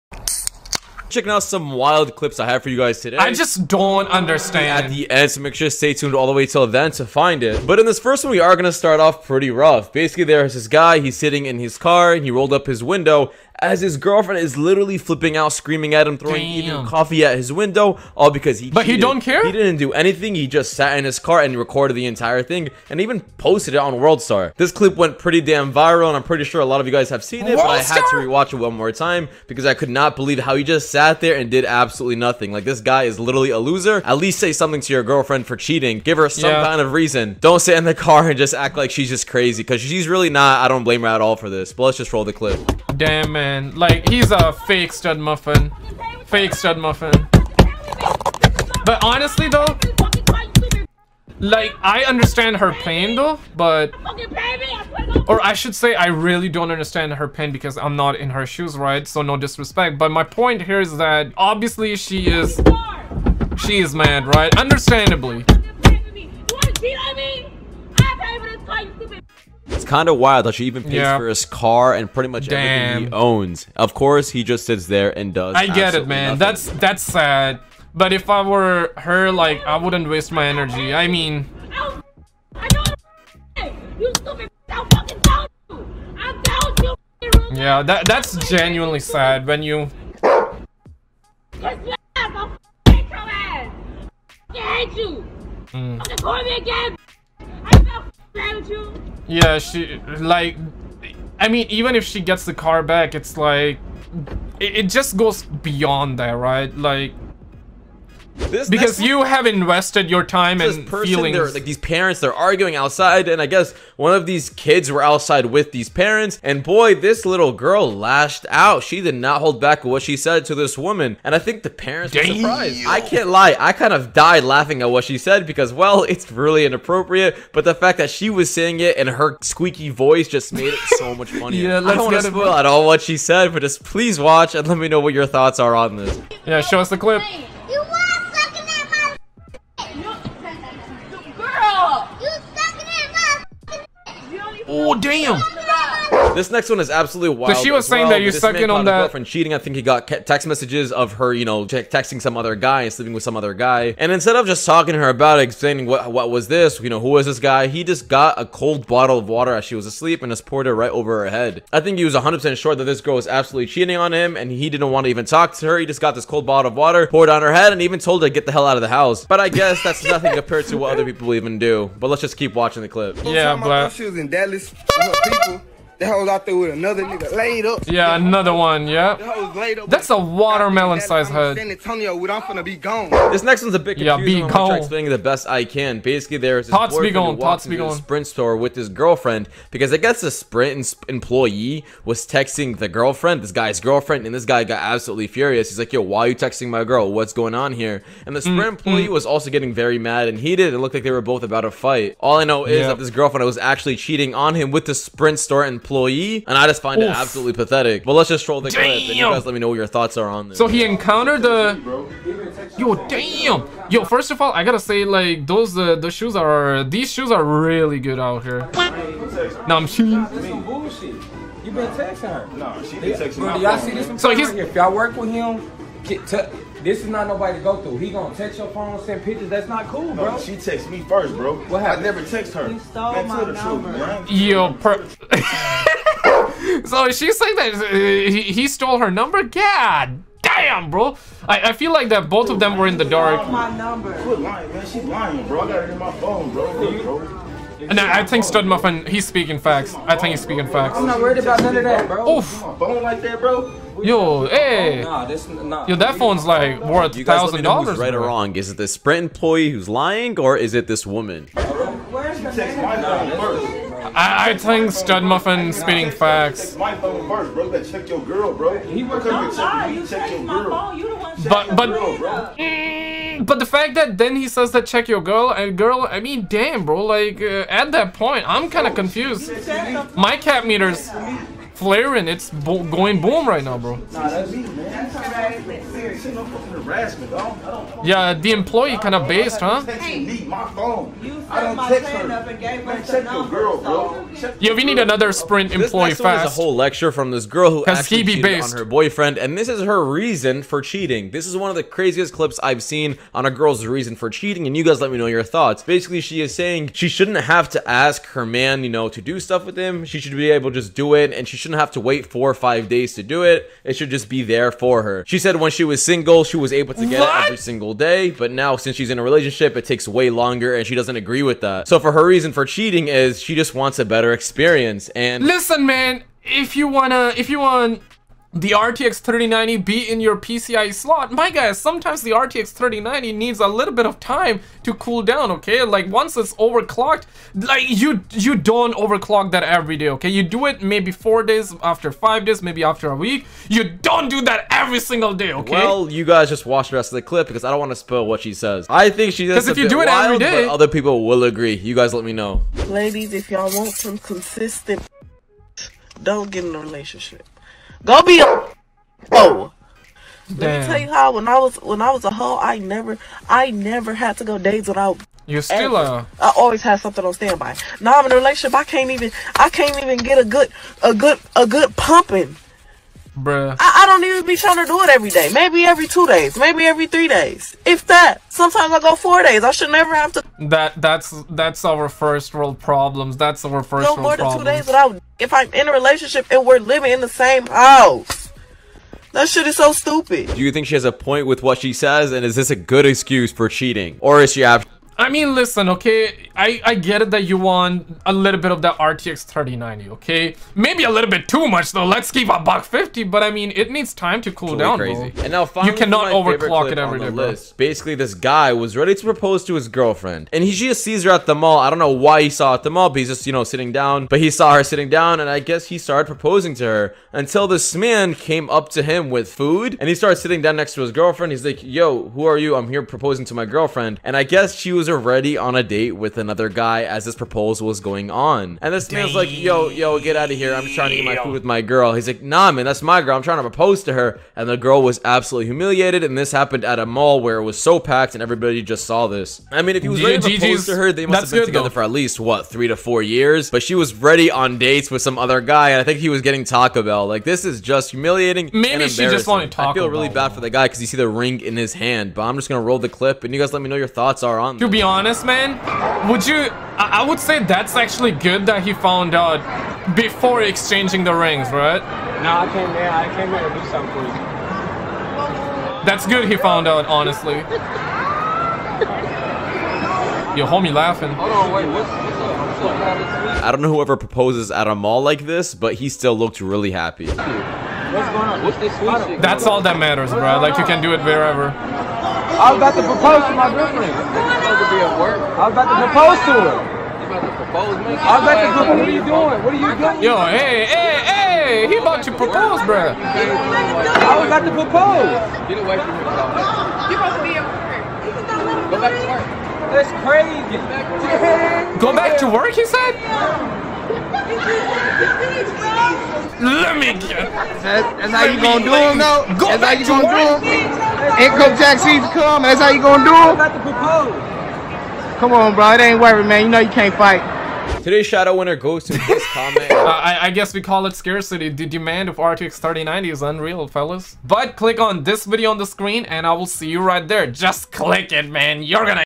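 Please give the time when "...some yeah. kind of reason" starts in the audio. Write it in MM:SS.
00:36.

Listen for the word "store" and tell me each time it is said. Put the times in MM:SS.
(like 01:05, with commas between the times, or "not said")
03:08, 03:25.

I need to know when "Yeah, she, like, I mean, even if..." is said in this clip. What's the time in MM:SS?
01:39.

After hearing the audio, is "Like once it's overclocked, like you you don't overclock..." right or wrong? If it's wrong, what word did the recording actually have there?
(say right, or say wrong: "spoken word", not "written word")
right.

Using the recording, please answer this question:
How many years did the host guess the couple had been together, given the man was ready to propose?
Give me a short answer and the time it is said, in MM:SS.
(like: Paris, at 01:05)
3 to 4 years, at 07:22.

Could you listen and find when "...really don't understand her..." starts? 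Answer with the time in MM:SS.
00:56.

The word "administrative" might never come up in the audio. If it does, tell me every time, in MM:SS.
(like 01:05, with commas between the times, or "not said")
not said.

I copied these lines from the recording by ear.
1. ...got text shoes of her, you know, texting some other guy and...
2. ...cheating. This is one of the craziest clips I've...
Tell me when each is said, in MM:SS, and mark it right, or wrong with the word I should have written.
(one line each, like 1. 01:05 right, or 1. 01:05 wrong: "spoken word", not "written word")
1. 02:29 wrong: "messages", not "shoes"
2. 05:00 right.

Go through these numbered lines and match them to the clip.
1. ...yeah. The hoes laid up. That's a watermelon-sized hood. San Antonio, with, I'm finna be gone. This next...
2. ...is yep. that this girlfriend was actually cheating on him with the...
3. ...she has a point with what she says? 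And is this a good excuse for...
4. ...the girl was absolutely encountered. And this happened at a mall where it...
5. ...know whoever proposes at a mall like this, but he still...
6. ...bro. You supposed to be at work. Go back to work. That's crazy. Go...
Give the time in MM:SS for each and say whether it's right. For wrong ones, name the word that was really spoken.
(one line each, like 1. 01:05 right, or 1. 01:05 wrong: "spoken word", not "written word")
1. 02:58 right
2. 03:22 right
3. 06:30 right
4. 07:14 wrong: "humiliated", not "encountered"
5. 07:53 right
6. 08:16 right.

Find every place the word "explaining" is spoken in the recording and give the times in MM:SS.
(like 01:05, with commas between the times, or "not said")
02:35, 03:04.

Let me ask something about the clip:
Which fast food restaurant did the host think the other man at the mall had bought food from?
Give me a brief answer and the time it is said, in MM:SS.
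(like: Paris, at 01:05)
Taco Bell, at 07:26.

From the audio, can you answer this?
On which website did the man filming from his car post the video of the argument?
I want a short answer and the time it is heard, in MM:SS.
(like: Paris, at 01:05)
WorldStar, at 00:23.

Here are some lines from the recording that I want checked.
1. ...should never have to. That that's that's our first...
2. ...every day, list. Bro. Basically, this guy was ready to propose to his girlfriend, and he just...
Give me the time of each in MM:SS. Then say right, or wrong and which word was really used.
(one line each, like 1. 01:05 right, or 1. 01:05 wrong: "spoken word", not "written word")
1. 06:19 right
2. 06:46 right.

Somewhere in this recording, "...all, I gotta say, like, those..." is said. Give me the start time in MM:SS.
03:34.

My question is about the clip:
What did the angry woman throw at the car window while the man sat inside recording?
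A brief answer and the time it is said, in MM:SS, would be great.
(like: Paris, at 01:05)
coffee, at 00:16.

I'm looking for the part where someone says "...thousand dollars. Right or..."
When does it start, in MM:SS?
04:17.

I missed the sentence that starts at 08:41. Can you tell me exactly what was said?
The demand of RTX 3090 is unreal, fellas.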